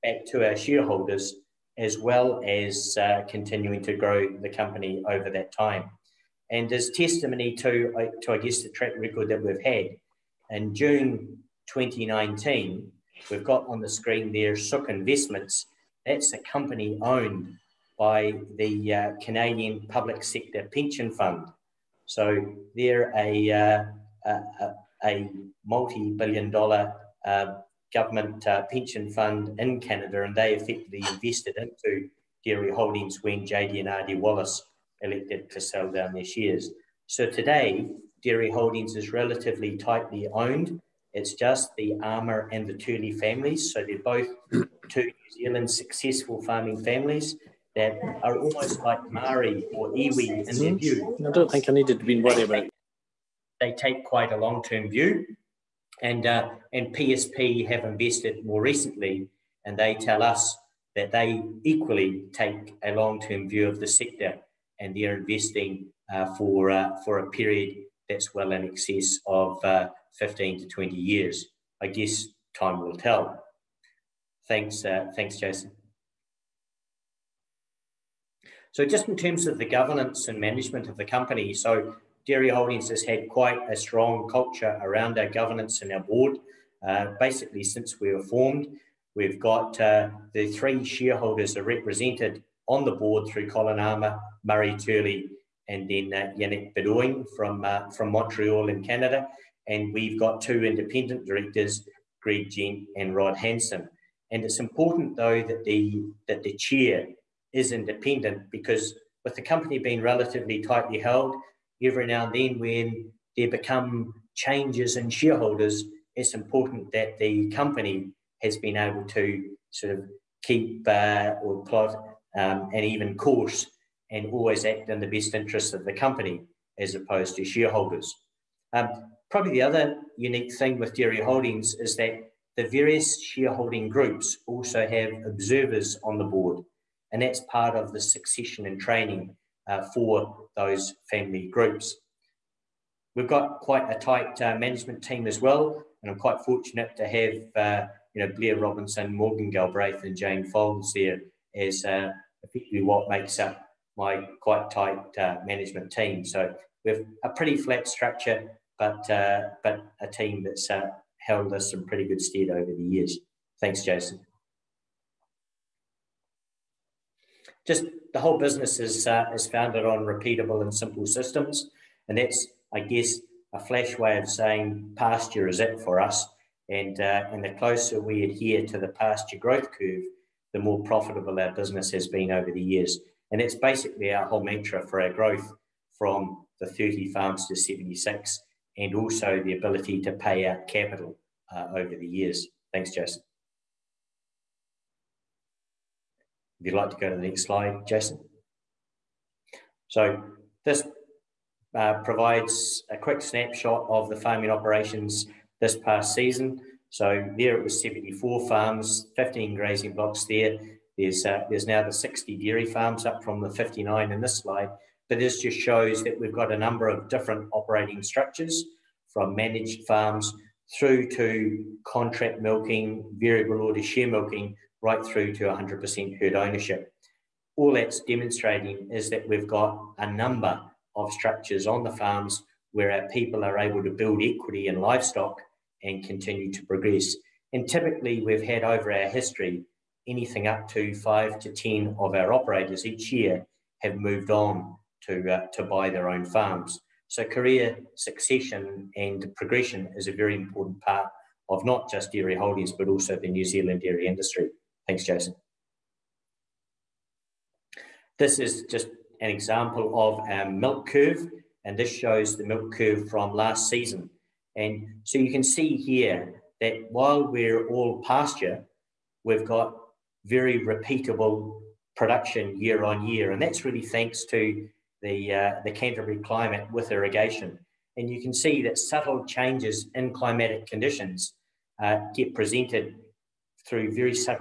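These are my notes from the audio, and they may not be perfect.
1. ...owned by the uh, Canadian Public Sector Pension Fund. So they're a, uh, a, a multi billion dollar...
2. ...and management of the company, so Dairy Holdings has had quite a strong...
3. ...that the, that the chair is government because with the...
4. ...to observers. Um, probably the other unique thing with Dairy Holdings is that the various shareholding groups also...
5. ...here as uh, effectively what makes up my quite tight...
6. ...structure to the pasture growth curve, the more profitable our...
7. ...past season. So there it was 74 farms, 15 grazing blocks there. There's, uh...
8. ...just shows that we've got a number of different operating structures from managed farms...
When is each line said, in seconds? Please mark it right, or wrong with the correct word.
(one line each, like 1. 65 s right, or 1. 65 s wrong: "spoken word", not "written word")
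1. 16 s right
2. 80 s right
3. 105 s wrong: "independent", not "government"
4. 127 s wrong: "shareholders", not "observers"
5. 150 s right
6. 178 s wrong: "adhere", not "structure"
7. 205 s right
8. 215 s right.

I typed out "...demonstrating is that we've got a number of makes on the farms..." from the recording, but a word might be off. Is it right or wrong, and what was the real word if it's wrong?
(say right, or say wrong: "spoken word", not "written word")
wrong: "structures", not "makes".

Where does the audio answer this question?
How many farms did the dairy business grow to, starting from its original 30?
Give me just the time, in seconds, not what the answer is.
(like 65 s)
187 s.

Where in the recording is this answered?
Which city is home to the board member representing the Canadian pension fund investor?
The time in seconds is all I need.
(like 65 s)
98 s.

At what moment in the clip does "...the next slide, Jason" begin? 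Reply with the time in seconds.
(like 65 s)
197 s.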